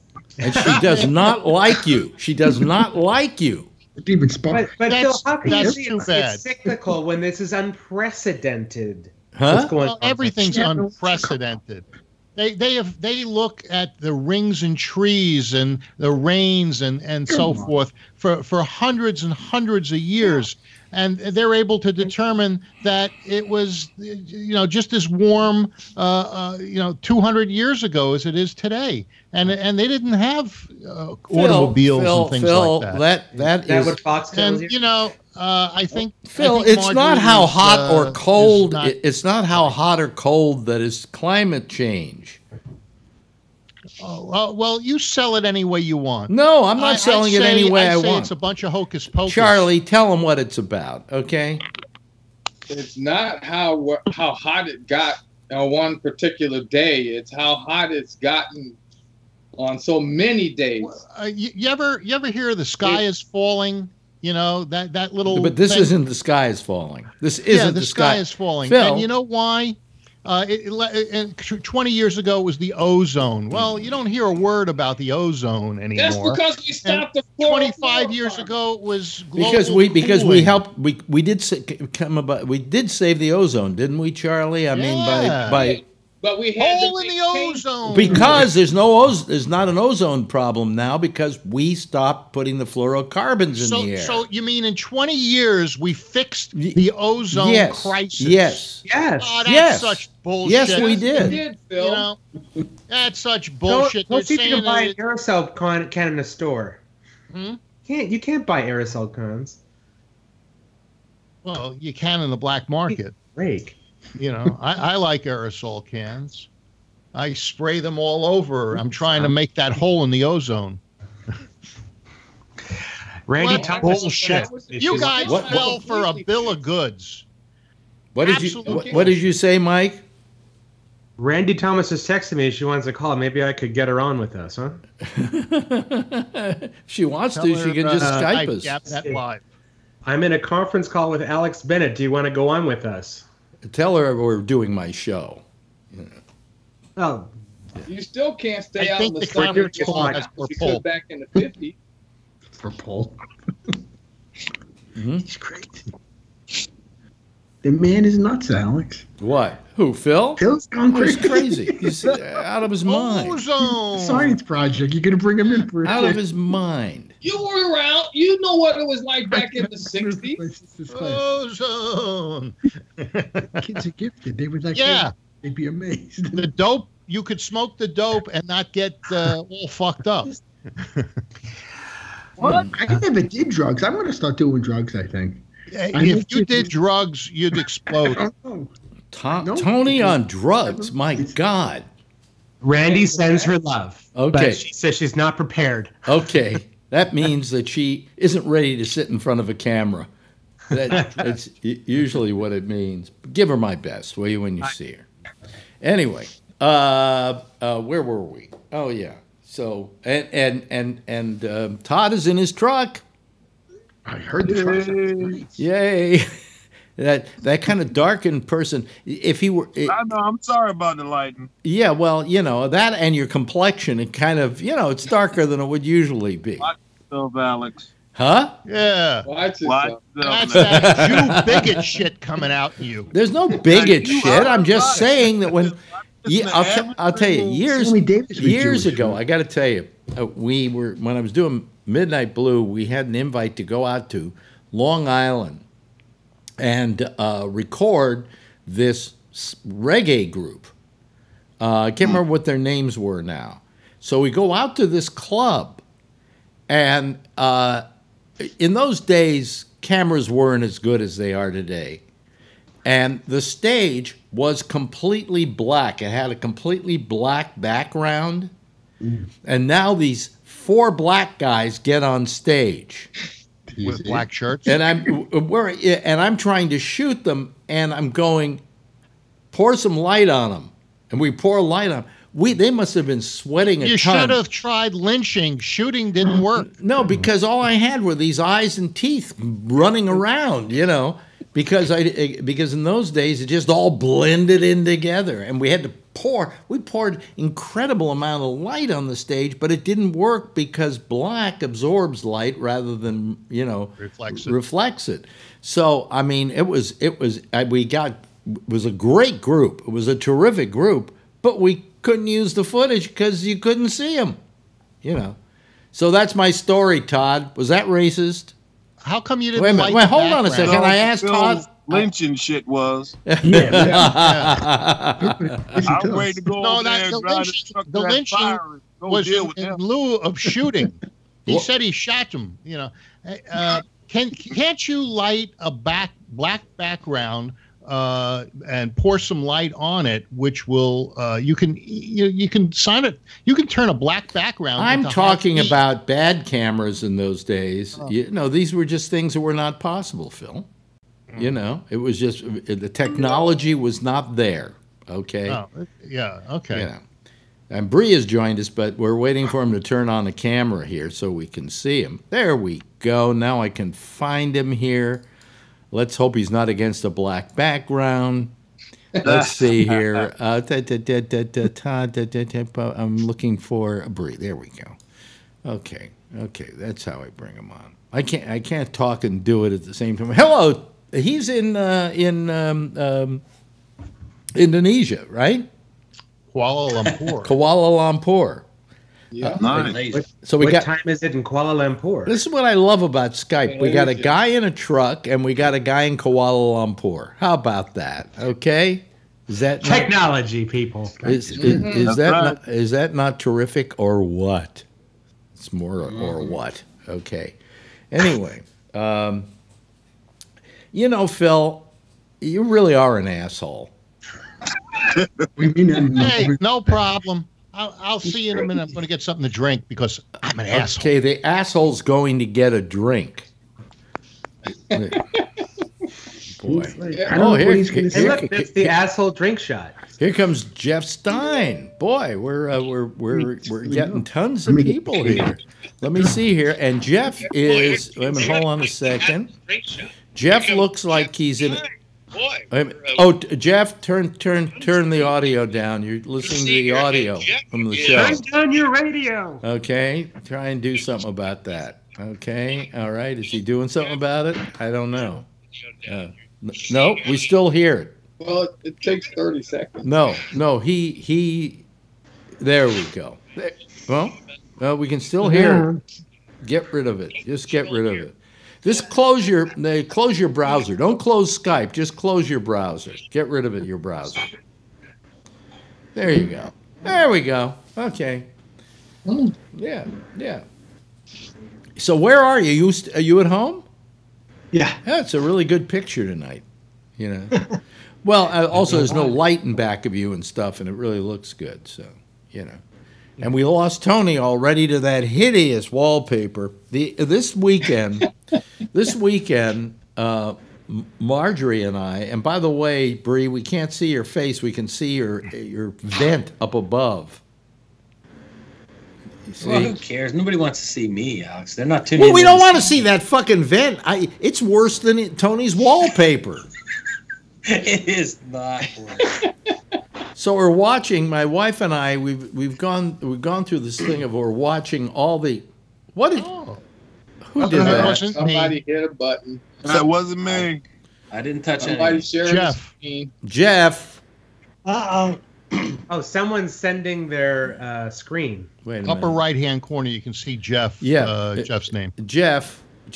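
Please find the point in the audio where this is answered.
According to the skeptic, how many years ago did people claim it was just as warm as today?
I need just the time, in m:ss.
0:27.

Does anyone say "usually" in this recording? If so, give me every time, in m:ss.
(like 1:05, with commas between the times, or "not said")
3:21, 3:45.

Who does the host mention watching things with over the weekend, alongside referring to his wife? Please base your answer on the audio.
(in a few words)
Marjorie.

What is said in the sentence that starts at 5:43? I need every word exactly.
You can turn a black background.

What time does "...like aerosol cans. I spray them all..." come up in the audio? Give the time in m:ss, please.
1:54.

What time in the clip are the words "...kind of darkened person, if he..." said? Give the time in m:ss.
3:37.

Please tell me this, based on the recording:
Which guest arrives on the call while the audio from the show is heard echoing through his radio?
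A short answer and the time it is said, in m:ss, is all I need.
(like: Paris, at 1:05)
Jeff Stein, at 7:10.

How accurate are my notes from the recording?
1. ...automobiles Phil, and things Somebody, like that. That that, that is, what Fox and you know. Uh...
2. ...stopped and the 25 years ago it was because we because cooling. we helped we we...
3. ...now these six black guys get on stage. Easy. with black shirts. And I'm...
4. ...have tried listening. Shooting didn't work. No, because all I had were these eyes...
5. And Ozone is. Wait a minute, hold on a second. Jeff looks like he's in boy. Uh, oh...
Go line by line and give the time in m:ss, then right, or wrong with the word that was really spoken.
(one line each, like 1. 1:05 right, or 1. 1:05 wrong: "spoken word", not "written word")
1. 0:31 wrong: "Phil", not "Somebody"
2. 1:16 right
3. 4:29 wrong: "four", not "six"
4. 4:44 wrong: "lynching", not "listening"
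5. 7:16 wrong: "Jeff", not "Ozone".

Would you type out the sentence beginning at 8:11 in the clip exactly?
So you know and we lost Tony already to that hideous wallpaper.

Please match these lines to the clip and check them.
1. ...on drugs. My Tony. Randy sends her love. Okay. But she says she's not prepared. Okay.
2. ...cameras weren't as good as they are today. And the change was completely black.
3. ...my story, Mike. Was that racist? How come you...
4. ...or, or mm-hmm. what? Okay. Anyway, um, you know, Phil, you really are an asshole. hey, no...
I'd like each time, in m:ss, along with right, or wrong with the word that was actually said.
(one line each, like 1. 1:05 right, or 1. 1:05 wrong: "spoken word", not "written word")
1. 3:10 wrong: "God", not "Tony"
2. 4:19 wrong: "stage", not "change"
3. 5:16 wrong: "Todd", not "Mike"
4. 6:46 right.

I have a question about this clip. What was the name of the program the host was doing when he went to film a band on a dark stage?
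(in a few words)
Midnight Blue.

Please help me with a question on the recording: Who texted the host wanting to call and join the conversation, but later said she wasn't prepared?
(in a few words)
Randy Thomas.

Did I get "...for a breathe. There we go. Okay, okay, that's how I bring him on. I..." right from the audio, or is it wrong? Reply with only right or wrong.
right.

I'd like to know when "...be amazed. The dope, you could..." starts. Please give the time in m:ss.
2:55.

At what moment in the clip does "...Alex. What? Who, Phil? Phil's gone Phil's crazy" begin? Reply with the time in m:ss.
2:38.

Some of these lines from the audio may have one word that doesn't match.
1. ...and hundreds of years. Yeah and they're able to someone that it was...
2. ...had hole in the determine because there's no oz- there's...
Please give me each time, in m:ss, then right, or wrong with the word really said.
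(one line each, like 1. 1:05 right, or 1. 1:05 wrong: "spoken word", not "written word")
1. 0:19 wrong: "determine", not "someone"
2. 1:26 wrong: "ozone", not "determine".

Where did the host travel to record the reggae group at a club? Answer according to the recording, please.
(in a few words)
Long Island.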